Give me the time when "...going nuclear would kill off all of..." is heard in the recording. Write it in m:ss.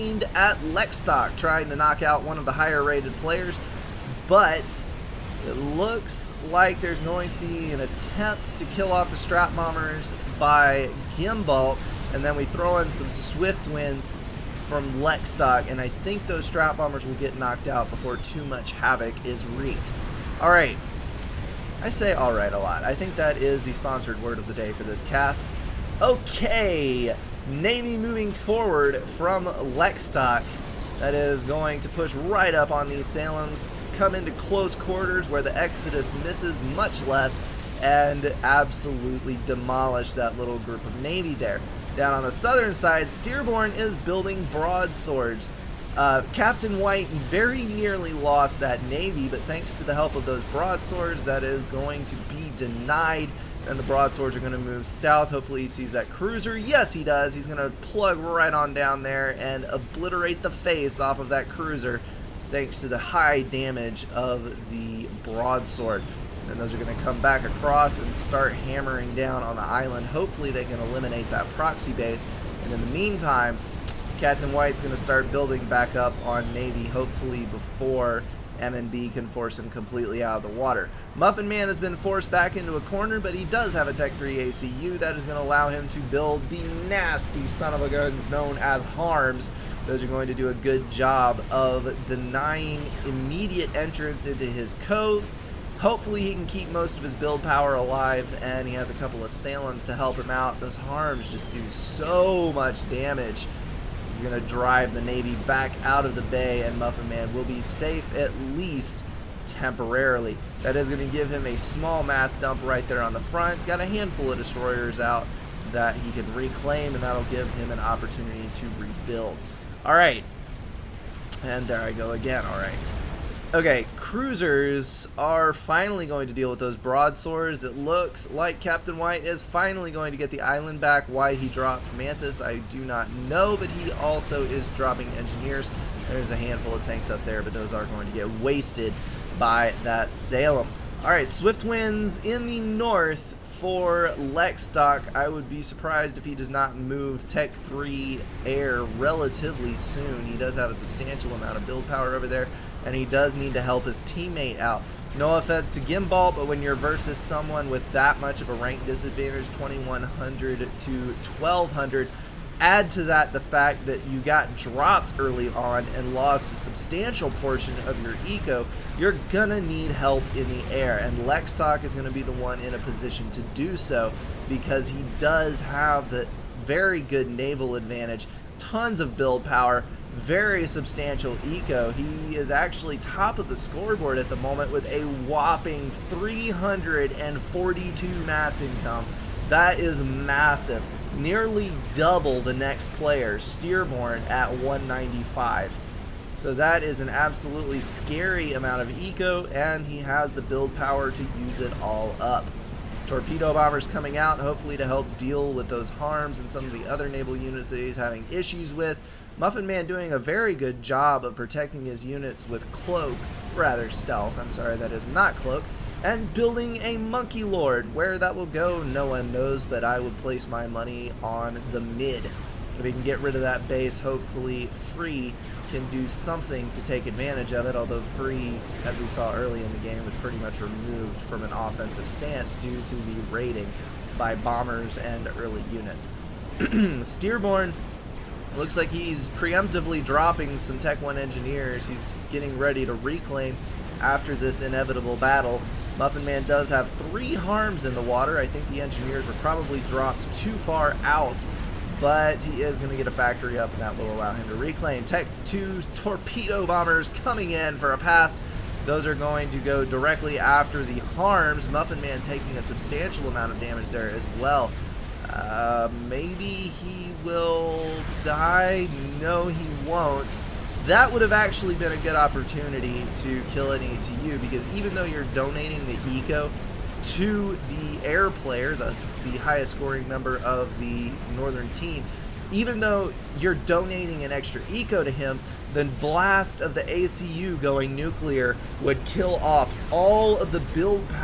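4:47.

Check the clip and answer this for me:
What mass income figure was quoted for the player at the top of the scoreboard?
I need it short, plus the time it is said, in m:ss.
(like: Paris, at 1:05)
342, at 3:06.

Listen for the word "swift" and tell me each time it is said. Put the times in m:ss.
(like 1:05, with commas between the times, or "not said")
0:13, 2:21.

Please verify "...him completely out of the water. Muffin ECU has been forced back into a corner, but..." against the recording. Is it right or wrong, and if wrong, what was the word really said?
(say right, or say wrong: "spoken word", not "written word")
wrong: "Man", not "ECU".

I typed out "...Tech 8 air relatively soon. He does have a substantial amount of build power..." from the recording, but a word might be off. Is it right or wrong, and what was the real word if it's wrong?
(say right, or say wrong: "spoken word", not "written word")
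wrong: "3", not "8".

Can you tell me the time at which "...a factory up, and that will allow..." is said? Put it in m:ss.
4:13.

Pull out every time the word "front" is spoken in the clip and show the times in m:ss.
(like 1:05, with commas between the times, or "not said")
1:53.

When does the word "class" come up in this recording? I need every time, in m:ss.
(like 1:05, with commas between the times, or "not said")
not said.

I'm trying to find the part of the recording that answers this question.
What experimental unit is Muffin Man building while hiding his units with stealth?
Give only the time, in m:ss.
3:36.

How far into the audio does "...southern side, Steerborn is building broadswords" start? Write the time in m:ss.
0:42.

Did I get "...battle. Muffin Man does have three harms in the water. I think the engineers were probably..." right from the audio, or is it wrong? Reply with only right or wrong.
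right.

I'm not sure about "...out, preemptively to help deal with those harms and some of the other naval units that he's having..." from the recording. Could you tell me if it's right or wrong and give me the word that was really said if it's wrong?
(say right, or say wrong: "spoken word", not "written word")
wrong: "hopefully", not "preemptively".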